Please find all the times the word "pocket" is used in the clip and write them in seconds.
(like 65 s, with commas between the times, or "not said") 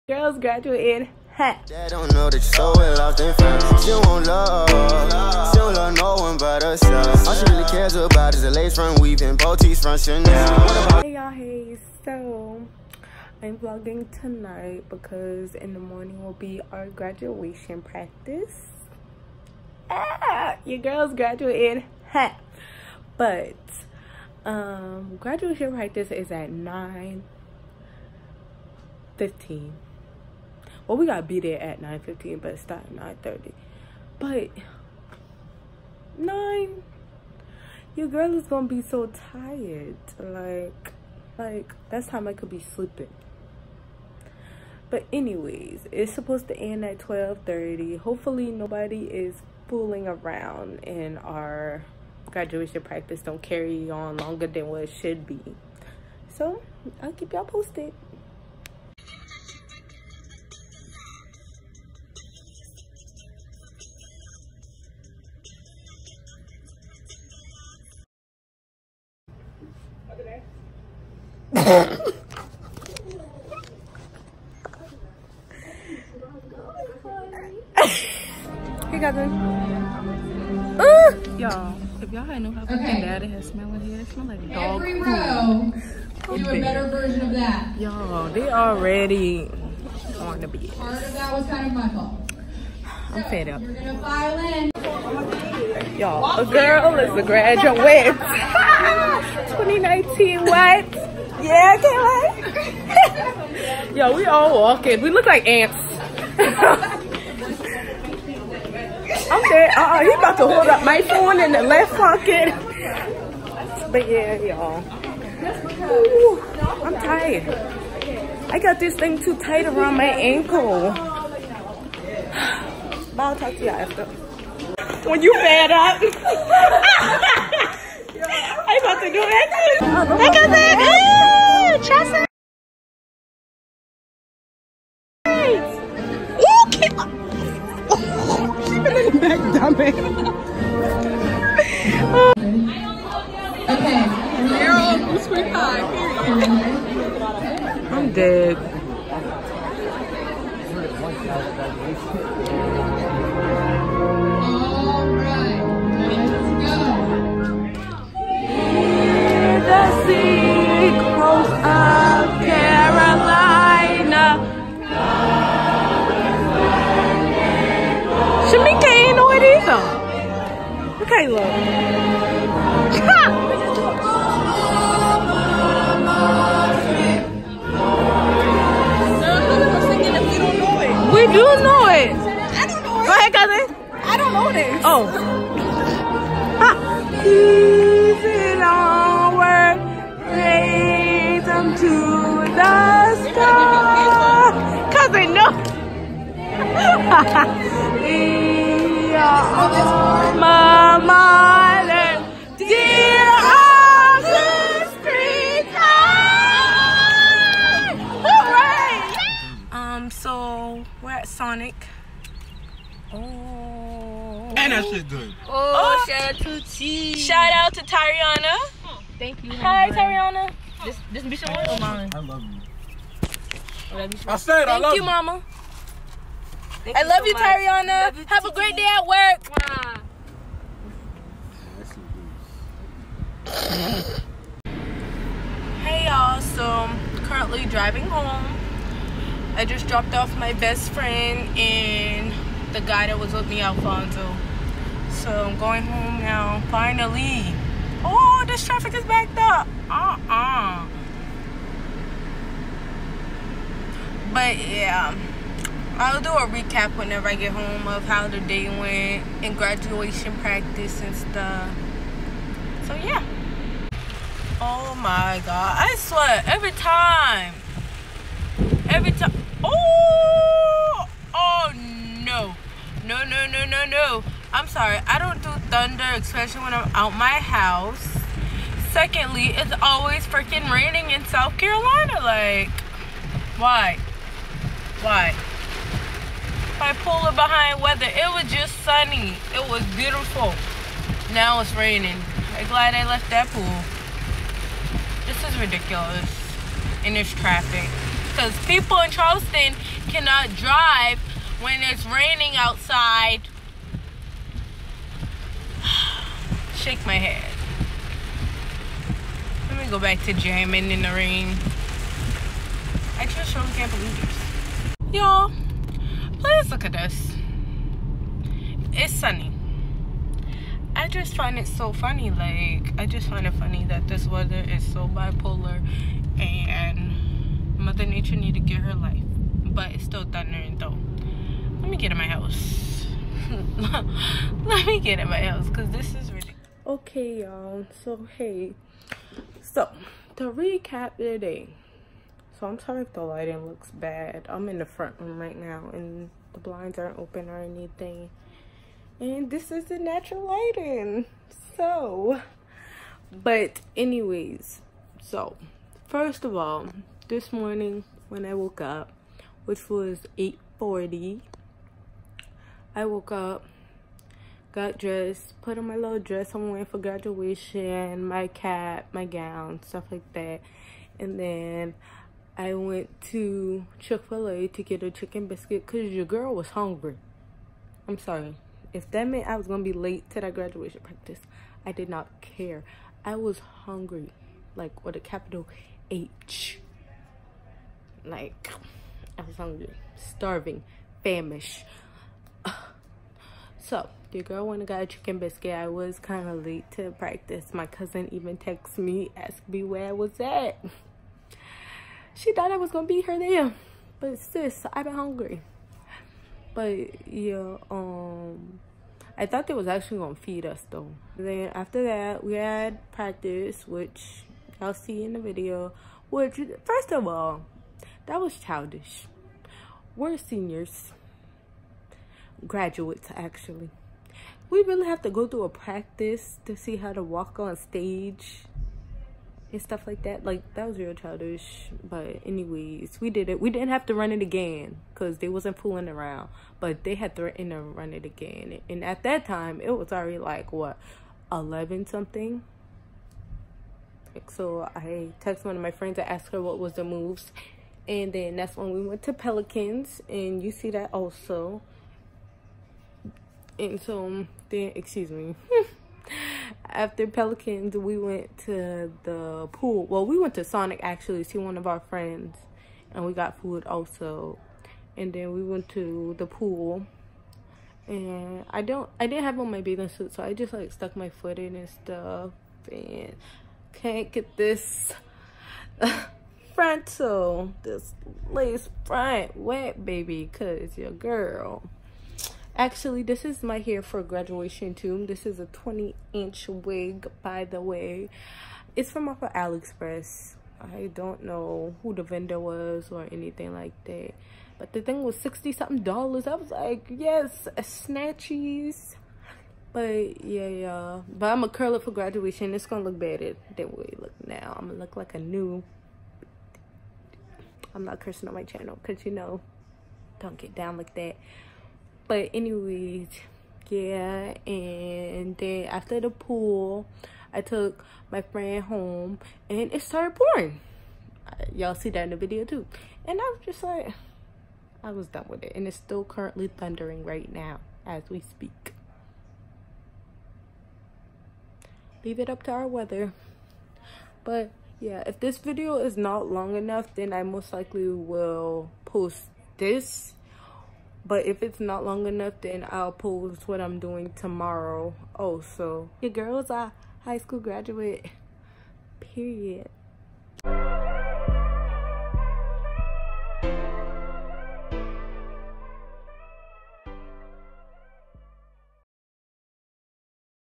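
111 s.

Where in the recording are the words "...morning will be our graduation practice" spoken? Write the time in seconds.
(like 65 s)
15 s.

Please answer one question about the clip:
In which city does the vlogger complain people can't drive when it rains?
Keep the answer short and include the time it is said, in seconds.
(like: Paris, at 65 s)
Charleston, at 299 s.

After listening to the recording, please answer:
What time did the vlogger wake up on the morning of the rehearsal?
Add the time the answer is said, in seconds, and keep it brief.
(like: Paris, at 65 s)
8:40, at 360 s.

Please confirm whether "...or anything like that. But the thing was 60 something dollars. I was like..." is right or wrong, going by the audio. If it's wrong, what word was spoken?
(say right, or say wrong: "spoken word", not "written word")
right.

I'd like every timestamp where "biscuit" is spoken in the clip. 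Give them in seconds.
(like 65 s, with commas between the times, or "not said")
375 s, 395 s.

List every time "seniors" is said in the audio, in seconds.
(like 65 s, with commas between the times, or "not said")
420 s.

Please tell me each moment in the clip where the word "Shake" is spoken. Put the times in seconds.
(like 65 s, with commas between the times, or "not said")
306 s.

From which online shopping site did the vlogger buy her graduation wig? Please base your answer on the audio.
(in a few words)
AliExpress.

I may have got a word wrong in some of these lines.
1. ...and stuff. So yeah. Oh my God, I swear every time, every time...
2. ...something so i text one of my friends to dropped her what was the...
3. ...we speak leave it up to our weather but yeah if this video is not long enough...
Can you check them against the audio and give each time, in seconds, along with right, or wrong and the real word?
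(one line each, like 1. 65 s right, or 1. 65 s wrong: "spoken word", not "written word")
1. 261 s right
2. 442 s wrong: "asked", not "dropped"
3. 528 s right.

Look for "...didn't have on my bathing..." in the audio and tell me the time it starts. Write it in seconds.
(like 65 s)
469 s.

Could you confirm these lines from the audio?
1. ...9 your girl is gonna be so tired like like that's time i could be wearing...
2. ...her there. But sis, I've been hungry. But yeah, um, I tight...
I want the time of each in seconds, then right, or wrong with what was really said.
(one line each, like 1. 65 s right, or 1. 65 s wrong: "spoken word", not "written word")
1. 36 s wrong: "sleeping", not "wearing"
2. 403 s wrong: "thought", not "tight".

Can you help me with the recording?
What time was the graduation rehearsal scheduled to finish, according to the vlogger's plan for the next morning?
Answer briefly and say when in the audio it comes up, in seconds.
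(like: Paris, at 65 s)
12:30, at 46 s.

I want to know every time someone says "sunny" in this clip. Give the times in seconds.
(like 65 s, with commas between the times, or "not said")
288 s, 319 s.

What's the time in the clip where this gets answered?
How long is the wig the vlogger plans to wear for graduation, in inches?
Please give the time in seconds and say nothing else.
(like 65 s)
485 s.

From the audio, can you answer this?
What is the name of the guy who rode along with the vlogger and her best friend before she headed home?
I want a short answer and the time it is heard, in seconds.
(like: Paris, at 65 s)
Alfonso, at 243 s.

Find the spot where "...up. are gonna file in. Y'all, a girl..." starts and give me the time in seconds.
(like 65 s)
93 s.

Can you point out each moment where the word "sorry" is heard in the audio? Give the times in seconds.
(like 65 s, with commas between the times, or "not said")
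274 s, 342 s, 378 s.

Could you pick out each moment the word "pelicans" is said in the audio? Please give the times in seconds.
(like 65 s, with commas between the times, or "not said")
449 s, 457 s.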